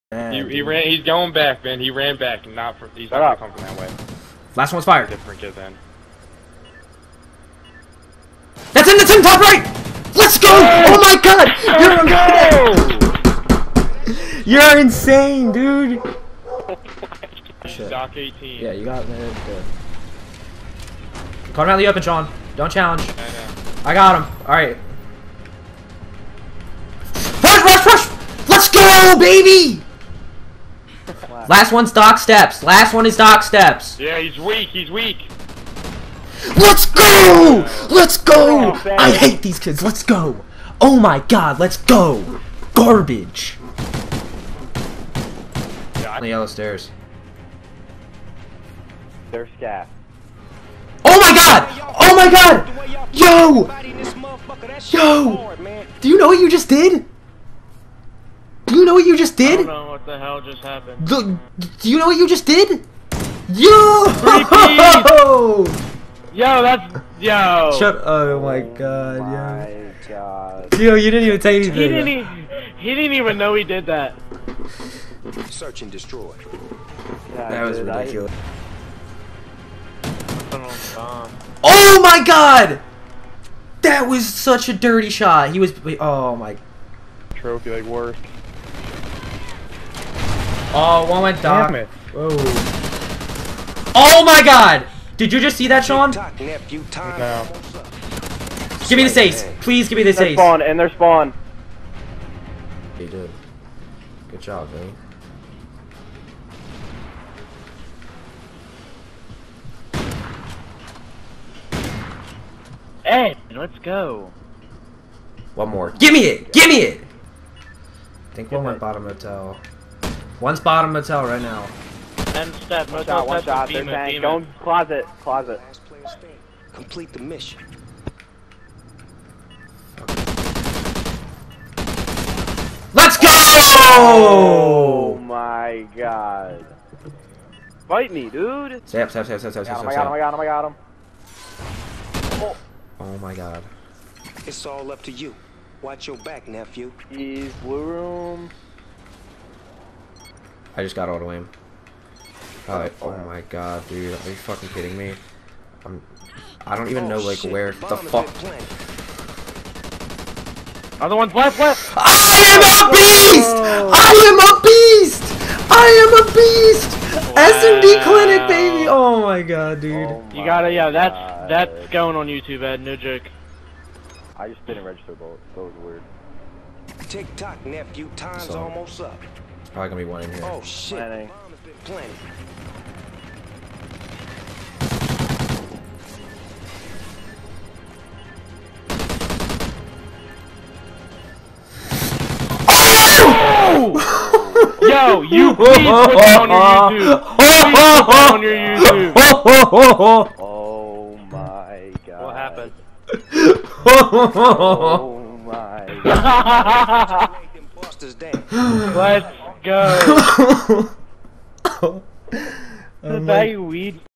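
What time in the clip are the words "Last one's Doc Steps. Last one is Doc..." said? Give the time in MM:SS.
00:31.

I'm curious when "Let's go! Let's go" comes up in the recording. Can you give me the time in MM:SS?
00:36.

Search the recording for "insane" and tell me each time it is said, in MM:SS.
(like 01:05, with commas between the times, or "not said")
00:14.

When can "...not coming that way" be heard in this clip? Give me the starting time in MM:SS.
00:03.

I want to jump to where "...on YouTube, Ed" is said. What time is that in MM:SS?
02:52.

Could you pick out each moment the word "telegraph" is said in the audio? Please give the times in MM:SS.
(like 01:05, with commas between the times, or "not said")
not said.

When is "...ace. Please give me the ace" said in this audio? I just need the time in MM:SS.
01:39.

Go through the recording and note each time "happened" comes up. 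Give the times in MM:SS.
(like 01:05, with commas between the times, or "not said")
01:00, 03:22.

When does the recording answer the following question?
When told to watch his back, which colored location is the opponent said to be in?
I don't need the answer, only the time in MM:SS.
02:27.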